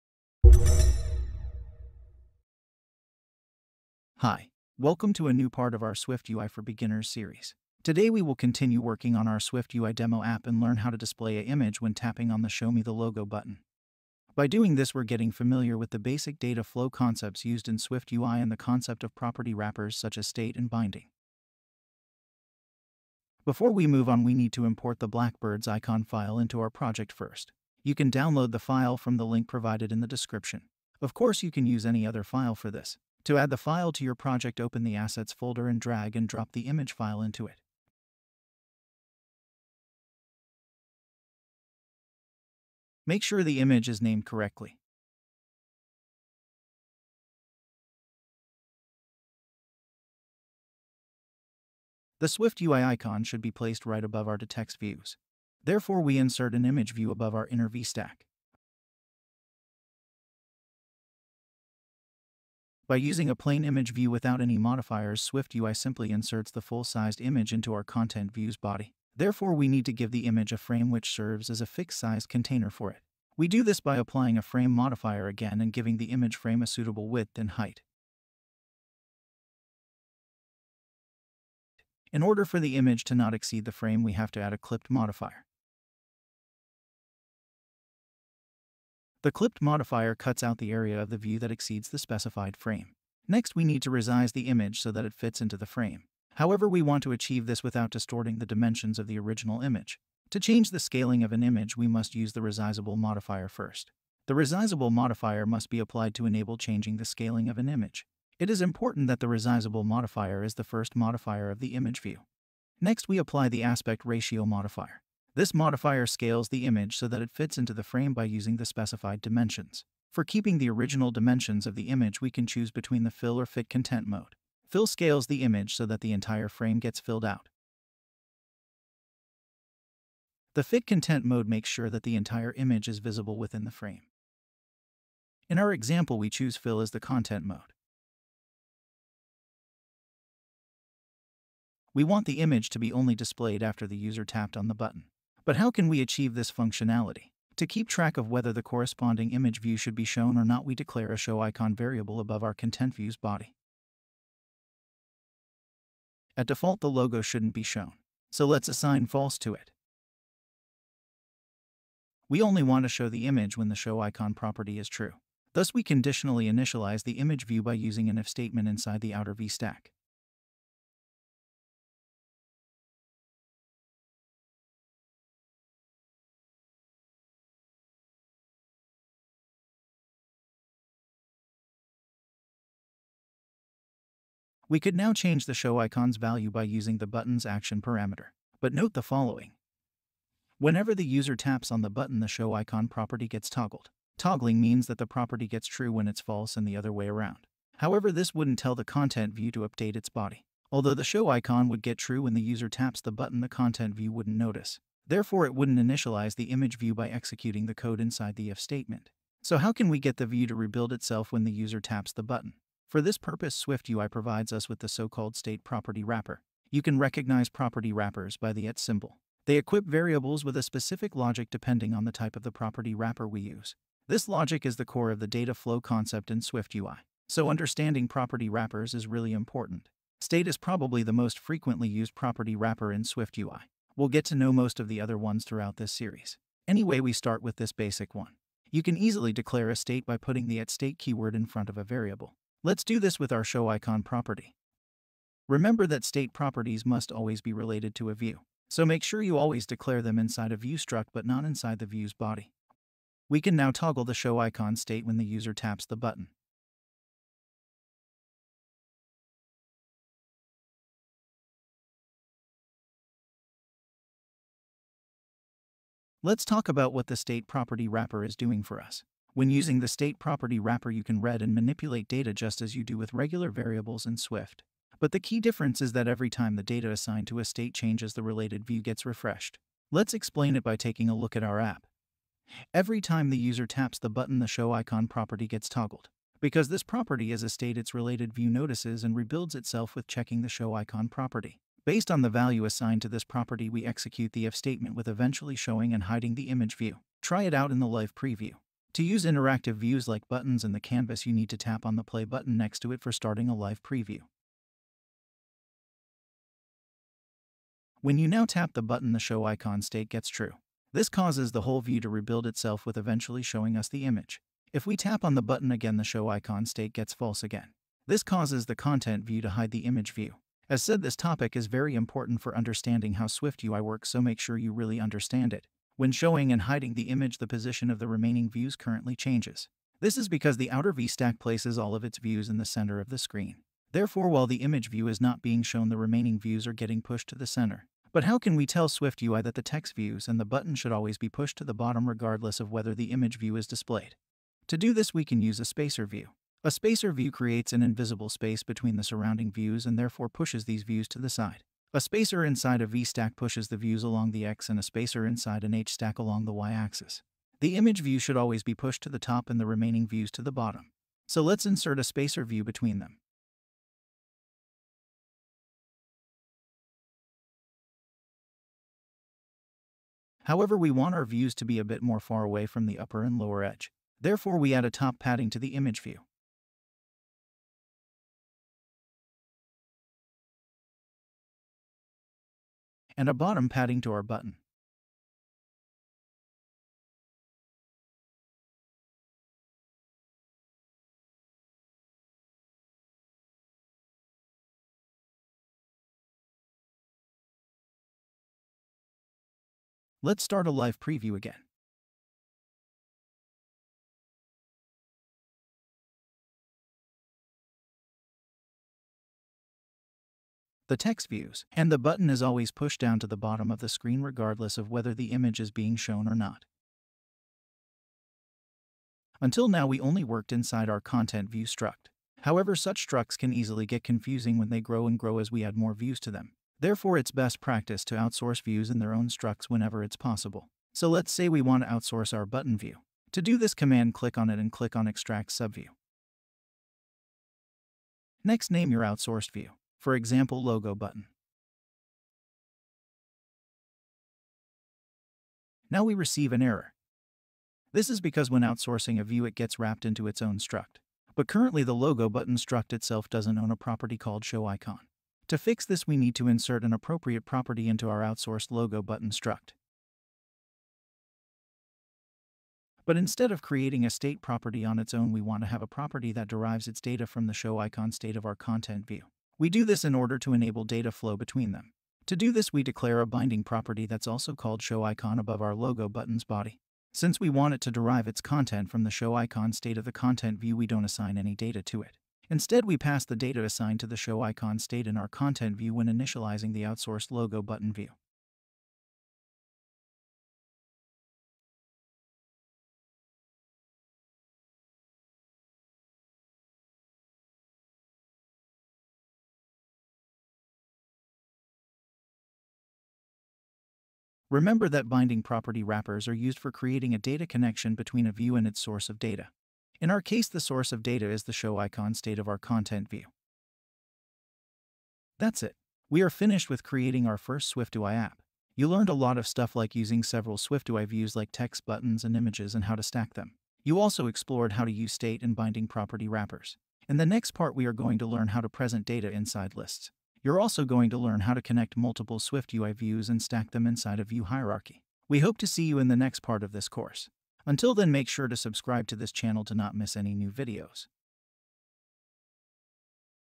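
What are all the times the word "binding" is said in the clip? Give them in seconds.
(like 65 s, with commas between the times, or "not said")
20 s, 473 s, 505 s, 525 s.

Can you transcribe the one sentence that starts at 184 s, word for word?
We could now change the show icon's value by using the button's action parameter.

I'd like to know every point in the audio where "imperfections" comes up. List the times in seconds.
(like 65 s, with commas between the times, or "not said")
not said.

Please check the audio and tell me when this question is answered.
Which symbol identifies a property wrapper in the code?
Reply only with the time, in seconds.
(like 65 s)
218 s.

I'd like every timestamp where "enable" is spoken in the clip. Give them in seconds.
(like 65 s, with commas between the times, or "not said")
106 s, 470 s.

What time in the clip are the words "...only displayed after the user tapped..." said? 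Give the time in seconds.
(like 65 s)
142 s.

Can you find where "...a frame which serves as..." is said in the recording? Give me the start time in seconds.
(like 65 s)
70 s.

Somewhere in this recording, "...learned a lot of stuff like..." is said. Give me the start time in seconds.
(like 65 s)
518 s.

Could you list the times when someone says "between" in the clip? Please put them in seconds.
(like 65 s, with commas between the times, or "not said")
122 s, 348 s, 362 s, 471 s, 507 s.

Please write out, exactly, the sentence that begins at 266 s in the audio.
Let's talk about what the state property wrapper is doing for us.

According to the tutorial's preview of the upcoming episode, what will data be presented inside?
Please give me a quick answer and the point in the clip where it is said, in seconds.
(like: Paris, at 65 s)
lists, at 529 s.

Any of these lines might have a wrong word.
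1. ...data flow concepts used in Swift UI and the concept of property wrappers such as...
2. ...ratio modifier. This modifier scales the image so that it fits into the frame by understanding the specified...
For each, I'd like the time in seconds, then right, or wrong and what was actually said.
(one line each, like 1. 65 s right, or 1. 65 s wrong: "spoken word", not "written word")
1. 16 s right
2. 114 s wrong: "using", not "understanding".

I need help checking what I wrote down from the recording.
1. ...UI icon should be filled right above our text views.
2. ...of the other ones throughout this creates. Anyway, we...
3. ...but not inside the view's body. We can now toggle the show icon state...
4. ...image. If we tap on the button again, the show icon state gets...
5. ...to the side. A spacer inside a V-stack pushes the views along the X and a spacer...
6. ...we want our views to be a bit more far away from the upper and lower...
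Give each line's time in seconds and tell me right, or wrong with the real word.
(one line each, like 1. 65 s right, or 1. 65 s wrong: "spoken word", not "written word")
1. 52 s wrong: "placed", not "filled"
2. 234 s wrong: "series", not "creates"
3. 251 s right
4. 314 s right
5. 351 s right
6. 370 s right.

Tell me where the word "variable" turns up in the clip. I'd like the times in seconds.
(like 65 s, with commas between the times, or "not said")
151 s, 219 s, 241 s, 273 s.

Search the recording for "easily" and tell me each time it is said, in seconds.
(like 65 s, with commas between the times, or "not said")
238 s, 423 s.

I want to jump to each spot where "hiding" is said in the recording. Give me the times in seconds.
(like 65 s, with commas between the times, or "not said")
296 s, 326 s.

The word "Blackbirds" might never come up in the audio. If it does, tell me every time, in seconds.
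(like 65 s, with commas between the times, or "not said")
25 s.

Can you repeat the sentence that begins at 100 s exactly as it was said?
To change the scaling of an image, we must use the resizable modifier first.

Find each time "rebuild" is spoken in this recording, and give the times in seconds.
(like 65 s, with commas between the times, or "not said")
210 s, 289 s, 312 s.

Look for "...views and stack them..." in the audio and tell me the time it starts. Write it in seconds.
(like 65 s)
532 s.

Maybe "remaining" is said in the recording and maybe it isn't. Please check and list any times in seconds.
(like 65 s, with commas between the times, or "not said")
328 s, 335 s, 359 s.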